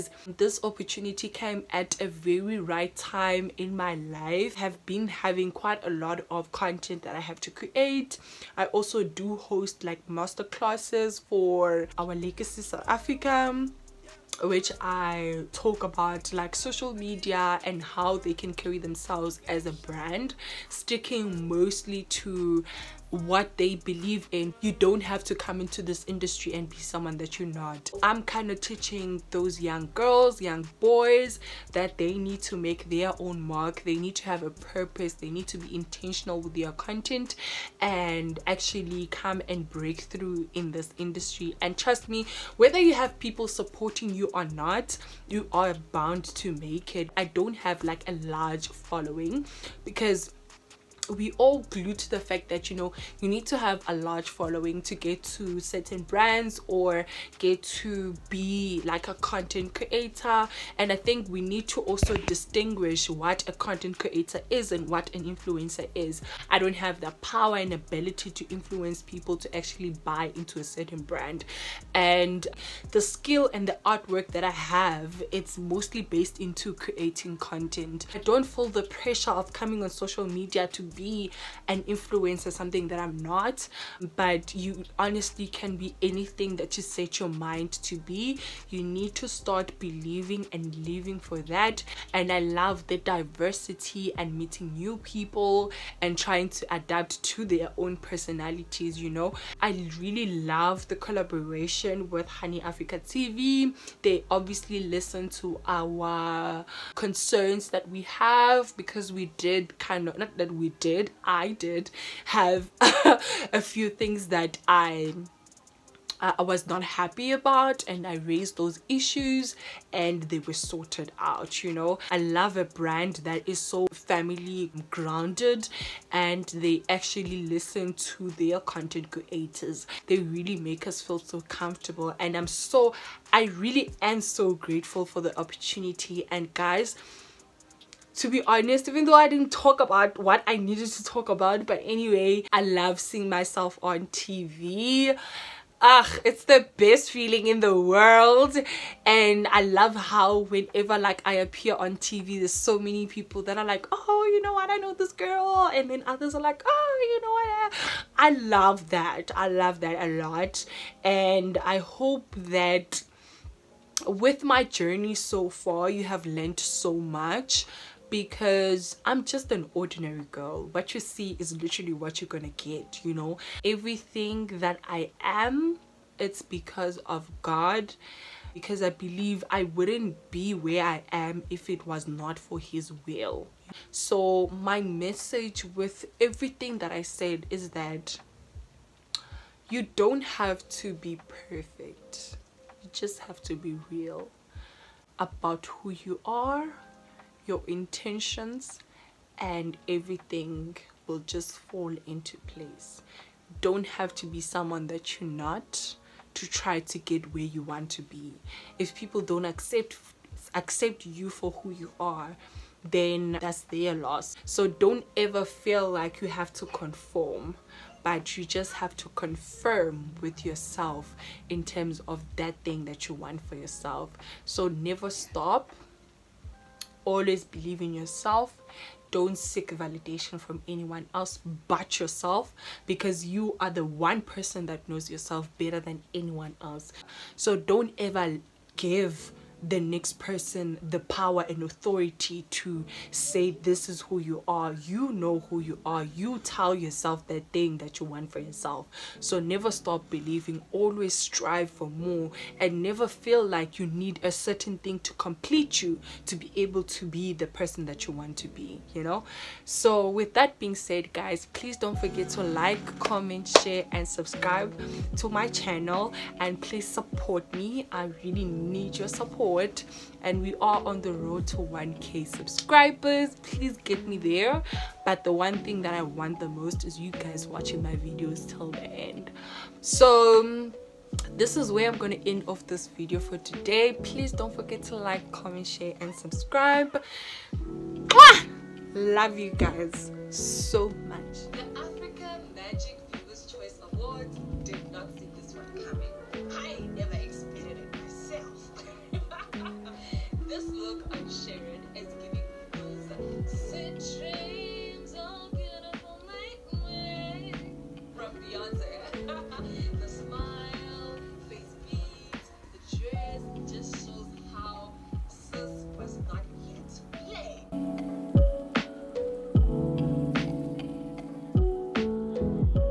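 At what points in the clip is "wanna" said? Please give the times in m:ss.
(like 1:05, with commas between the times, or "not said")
not said.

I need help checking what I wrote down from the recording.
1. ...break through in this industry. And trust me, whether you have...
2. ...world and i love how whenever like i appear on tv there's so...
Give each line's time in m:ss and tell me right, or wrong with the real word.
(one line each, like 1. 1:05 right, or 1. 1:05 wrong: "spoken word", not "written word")
1. 0:39 right
2. 2:27 right.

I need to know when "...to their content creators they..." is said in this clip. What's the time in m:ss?
2:08.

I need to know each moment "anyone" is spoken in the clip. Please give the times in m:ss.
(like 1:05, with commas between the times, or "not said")
3:50, 3:56.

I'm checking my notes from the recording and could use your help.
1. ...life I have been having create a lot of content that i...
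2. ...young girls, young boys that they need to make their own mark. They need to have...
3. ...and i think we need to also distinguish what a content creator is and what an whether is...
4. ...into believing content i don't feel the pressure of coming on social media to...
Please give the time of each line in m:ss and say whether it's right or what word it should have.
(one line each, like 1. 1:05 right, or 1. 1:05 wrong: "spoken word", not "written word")
1. 0:03 wrong: "quite", not "create"
2. 0:29 right
3. 1:00 wrong: "influencer", not "whether"
4. 1:16 wrong: "creating", not "believing".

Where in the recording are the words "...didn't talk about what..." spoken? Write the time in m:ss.
2:19.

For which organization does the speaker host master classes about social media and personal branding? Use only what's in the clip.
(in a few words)
Our Legacy South Africa.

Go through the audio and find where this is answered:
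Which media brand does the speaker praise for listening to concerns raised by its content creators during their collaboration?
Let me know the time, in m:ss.
1:42.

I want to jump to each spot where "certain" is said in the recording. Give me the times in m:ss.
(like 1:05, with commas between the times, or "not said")
0:55, 1:10, 4:14.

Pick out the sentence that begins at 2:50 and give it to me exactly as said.
What you see is literally what you're gonna get, you know.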